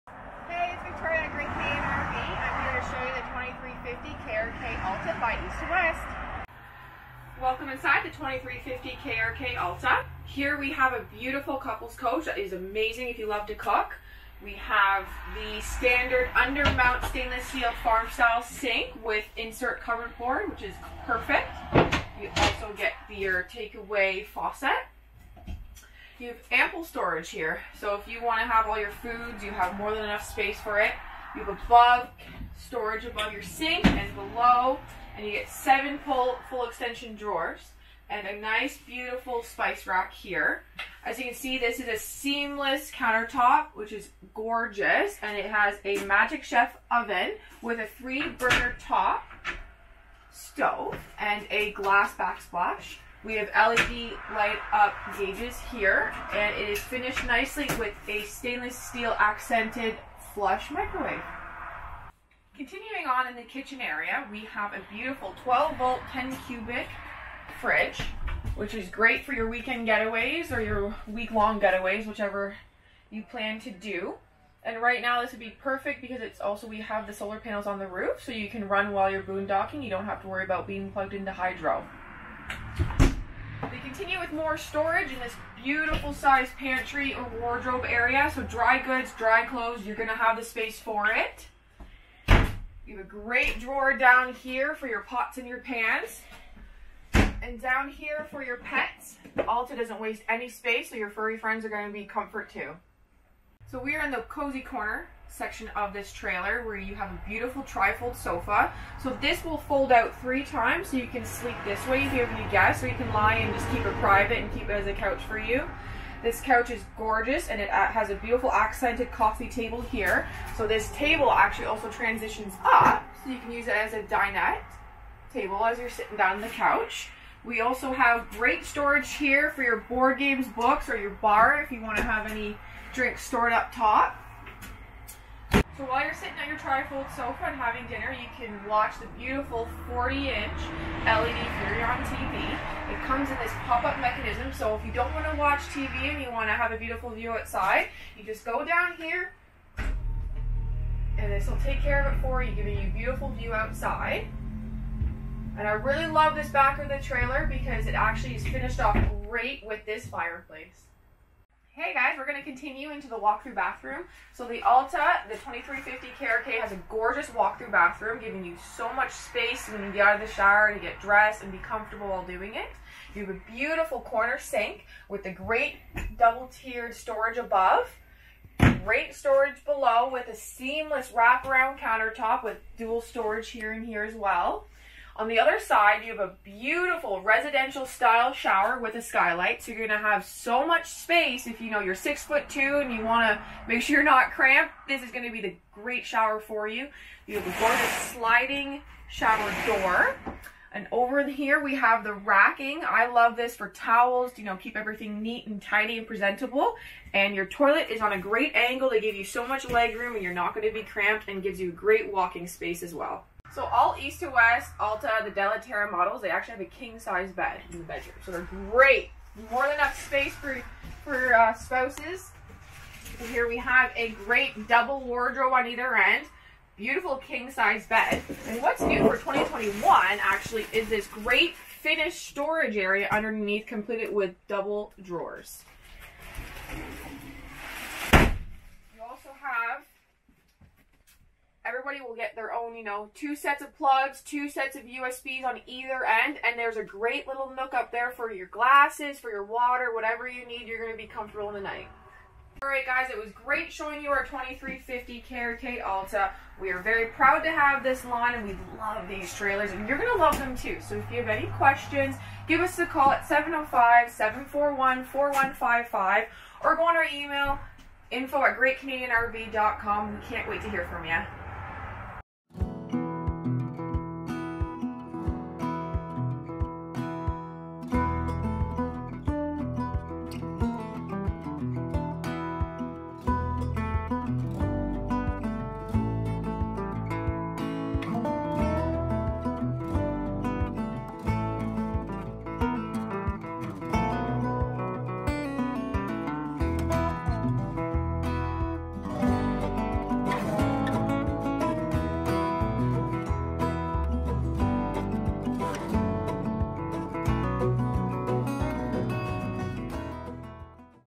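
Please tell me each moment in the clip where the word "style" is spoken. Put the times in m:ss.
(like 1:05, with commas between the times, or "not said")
0:18, 3:07.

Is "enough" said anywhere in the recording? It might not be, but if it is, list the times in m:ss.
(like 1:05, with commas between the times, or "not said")
0:30, 3:39.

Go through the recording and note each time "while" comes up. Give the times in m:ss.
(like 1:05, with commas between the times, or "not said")
1:18, 2:15, 2:52.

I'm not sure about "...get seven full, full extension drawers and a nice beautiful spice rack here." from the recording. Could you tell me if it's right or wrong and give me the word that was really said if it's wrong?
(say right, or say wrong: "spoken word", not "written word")
right.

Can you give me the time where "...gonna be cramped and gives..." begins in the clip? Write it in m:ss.
3:30.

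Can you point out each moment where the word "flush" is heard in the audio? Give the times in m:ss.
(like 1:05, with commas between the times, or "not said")
1:00.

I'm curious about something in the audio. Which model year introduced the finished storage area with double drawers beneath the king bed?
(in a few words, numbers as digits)
2021.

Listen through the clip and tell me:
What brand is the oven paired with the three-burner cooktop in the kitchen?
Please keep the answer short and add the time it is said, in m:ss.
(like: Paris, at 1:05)
Magic Chef, at 0:46.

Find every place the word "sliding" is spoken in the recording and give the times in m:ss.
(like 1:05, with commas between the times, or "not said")
3:18.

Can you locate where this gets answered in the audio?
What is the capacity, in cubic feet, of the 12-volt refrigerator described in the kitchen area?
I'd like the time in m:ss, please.
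1:06.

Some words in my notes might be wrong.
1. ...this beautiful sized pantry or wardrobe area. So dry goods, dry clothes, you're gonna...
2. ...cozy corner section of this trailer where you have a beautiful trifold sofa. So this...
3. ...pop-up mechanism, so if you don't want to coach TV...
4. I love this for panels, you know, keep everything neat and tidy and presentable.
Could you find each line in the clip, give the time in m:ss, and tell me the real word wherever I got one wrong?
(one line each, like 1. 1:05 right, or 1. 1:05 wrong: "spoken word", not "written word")
1. 1:25 right
2. 1:44 right
3. 2:23 wrong: "watch", not "coach"
4. 3:22 wrong: "towels", not "panels".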